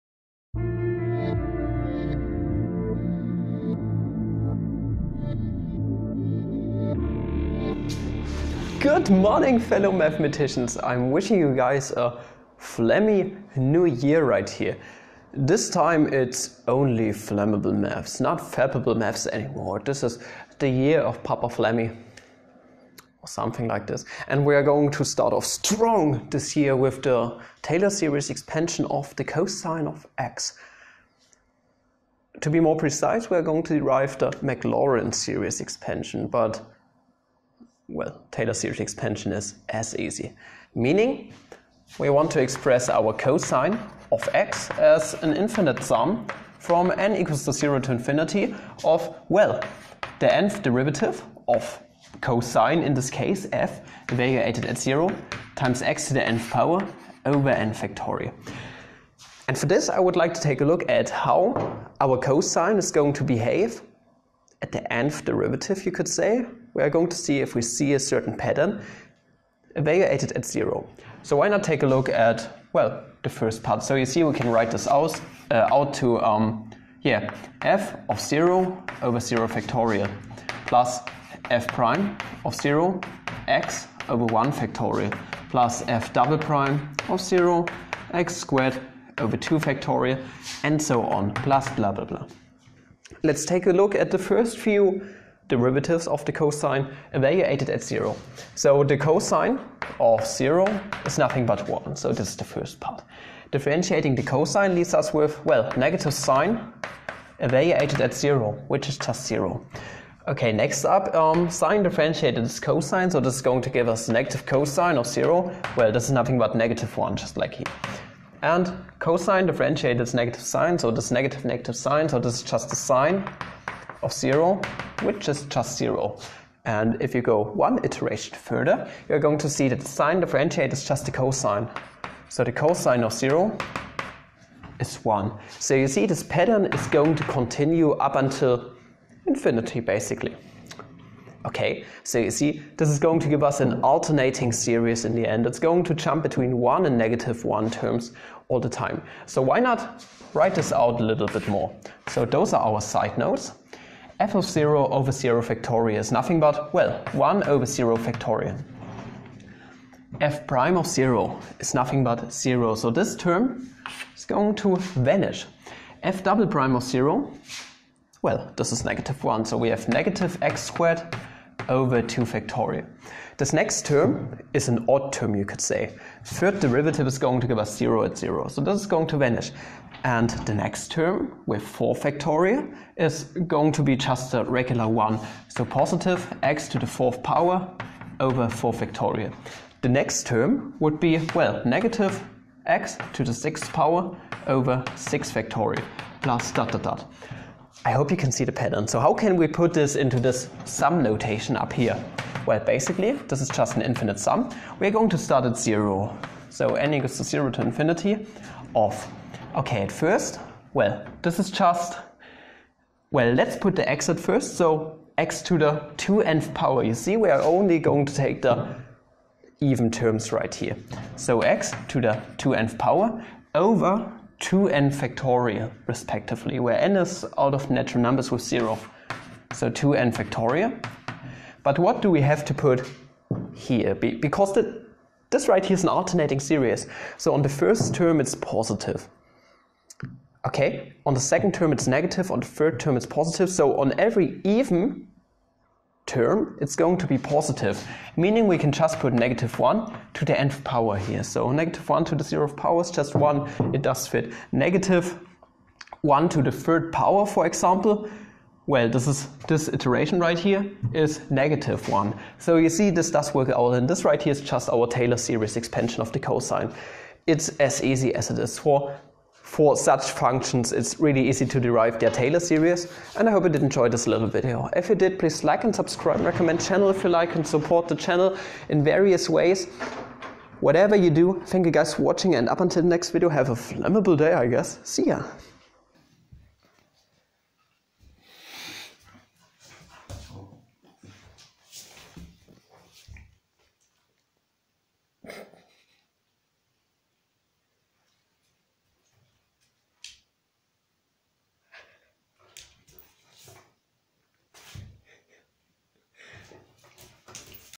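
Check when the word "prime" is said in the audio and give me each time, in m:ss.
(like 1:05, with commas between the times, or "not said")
1:21, 1:26, 2:40, 2:46.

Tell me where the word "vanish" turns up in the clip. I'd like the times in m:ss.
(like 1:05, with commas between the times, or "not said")
2:45, 2:59.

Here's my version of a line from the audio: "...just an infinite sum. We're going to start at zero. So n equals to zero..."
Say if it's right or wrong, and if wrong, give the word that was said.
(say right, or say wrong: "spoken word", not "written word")
right.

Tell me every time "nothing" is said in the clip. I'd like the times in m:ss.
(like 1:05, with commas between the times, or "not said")
1:41, 1:56, 2:36, 2:41.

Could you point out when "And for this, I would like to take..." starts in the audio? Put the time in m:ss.
0:59.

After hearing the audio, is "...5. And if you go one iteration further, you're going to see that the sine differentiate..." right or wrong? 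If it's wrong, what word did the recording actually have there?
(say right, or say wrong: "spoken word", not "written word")
wrong: "0", not "5".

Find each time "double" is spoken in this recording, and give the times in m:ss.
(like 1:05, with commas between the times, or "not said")
1:26, 2:46.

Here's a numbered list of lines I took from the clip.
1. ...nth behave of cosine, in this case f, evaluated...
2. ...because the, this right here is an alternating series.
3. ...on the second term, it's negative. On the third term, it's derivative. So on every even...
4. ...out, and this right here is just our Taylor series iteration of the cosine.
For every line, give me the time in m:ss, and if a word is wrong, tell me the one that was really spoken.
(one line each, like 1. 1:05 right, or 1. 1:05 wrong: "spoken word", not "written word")
1. 0:50 wrong: "derivative", not "behave"
2. 3:54 right
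3. 4:01 wrong: "positive", not "derivative"
4. 4:23 wrong: "expansion", not "iteration".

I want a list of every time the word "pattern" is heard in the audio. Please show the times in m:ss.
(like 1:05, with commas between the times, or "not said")
1:08, 2:16, 3:18.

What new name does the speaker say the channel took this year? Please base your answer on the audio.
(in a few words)
Flammable Maths.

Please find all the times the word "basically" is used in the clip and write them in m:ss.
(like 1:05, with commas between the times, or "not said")
2:19, 3:22.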